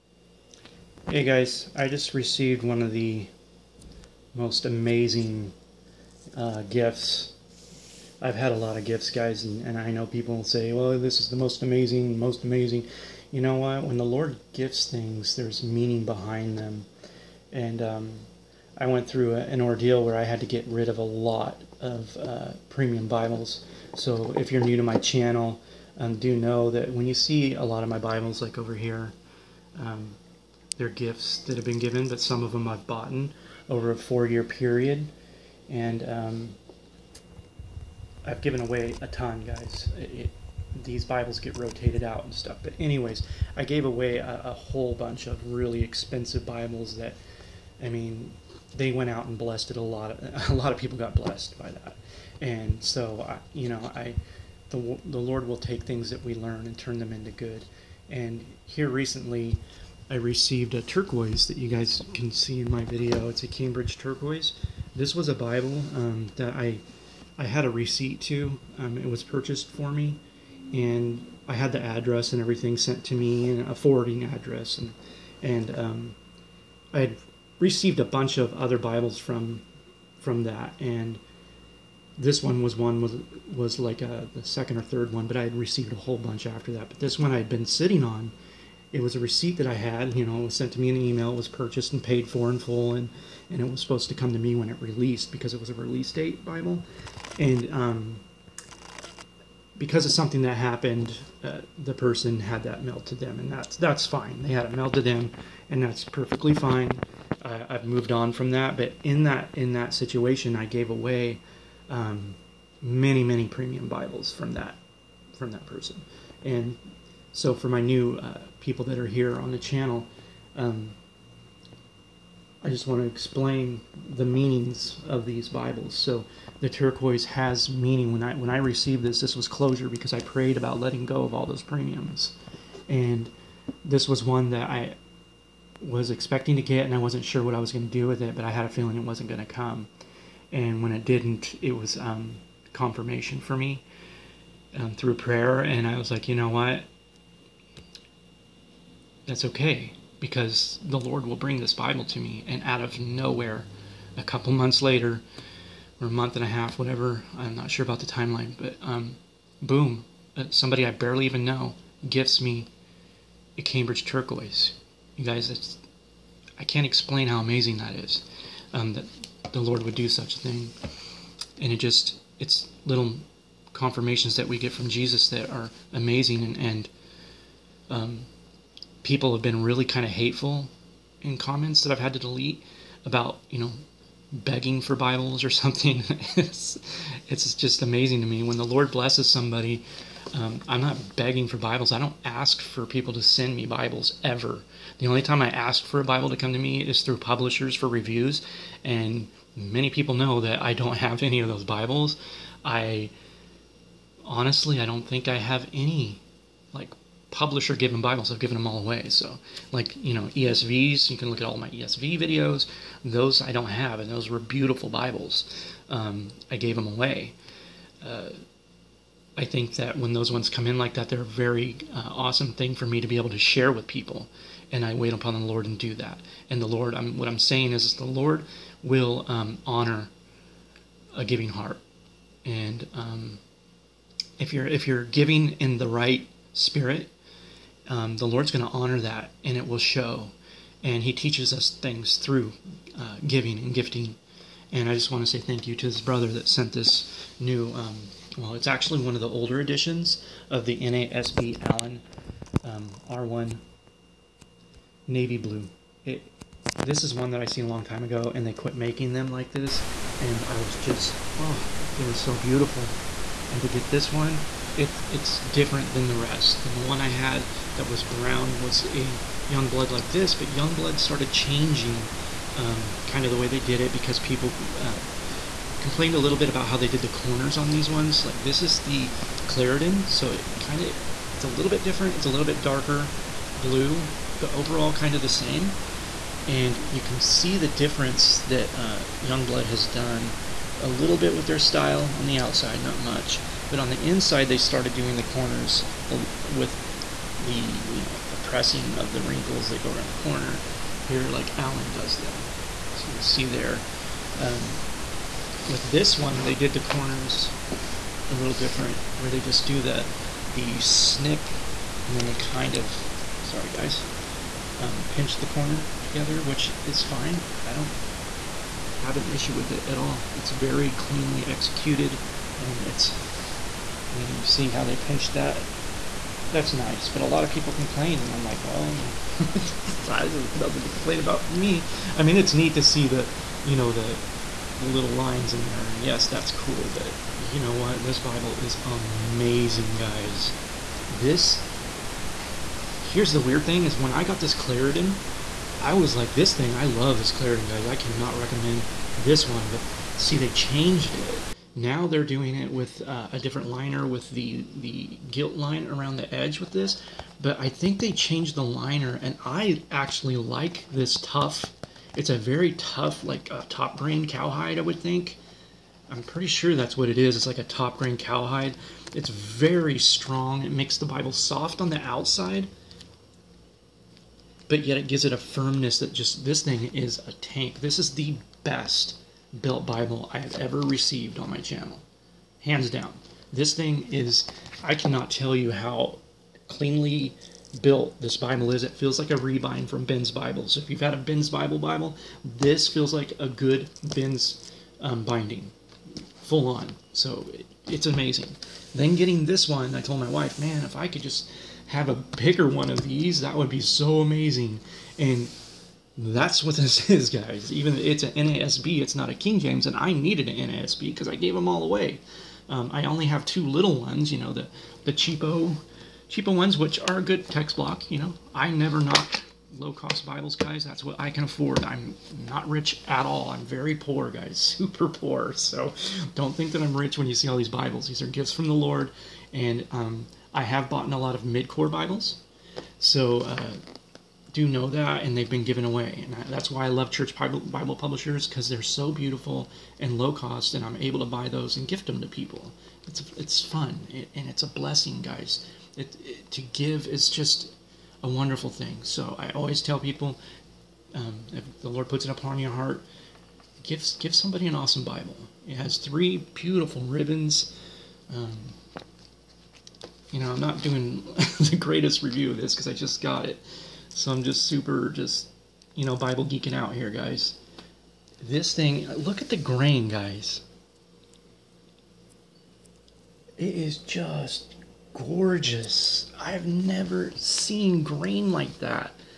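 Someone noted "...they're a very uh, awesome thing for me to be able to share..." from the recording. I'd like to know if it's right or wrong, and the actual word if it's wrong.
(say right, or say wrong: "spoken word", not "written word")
right.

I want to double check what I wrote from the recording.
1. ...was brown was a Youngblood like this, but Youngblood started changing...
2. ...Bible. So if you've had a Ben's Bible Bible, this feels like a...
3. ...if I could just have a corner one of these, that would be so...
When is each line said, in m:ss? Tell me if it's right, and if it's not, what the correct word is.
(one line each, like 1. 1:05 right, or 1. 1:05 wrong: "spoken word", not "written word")
1. 4:27 right
2. 6:30 right
3. 6:40 wrong: "bigger", not "corner".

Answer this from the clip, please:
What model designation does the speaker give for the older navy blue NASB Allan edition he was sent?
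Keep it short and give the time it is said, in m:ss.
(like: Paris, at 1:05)
R1, at 4:13.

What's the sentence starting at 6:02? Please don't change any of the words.
It's a very tough, like uh, top grain cowhide, I would think.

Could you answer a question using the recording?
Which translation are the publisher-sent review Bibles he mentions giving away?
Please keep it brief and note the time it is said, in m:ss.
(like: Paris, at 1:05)
ESV, at 3:30.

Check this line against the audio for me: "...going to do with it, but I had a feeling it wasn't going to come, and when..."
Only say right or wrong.
right.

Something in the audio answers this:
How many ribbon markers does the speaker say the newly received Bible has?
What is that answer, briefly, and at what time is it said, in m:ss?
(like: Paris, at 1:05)
3, at 7:35.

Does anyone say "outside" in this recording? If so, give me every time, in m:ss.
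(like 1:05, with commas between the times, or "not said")
4:52, 6:12.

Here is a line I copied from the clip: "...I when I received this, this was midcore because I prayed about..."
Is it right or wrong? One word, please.
wrong.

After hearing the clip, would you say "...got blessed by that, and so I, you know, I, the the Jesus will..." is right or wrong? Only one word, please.
wrong.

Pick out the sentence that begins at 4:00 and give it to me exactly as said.
And He teaches us things through uh, giving and gifting.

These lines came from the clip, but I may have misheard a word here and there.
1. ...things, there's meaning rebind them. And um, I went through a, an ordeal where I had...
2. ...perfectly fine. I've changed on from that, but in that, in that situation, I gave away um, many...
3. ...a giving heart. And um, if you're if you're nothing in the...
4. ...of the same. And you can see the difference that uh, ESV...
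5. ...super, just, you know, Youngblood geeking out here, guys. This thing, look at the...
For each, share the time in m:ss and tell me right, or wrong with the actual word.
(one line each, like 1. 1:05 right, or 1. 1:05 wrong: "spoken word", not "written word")
1. 0:14 wrong: "behind", not "rebind"
2. 1:46 wrong: "moved", not "changed"
3. 3:51 wrong: "giving", not "nothing"
4. 4:45 wrong: "Youngblood", not "ESV"
5. 7:44 wrong: "Bible", not "Youngblood".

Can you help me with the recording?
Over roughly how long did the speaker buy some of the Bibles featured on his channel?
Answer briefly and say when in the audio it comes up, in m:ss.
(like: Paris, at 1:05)
4 years, at 0:33.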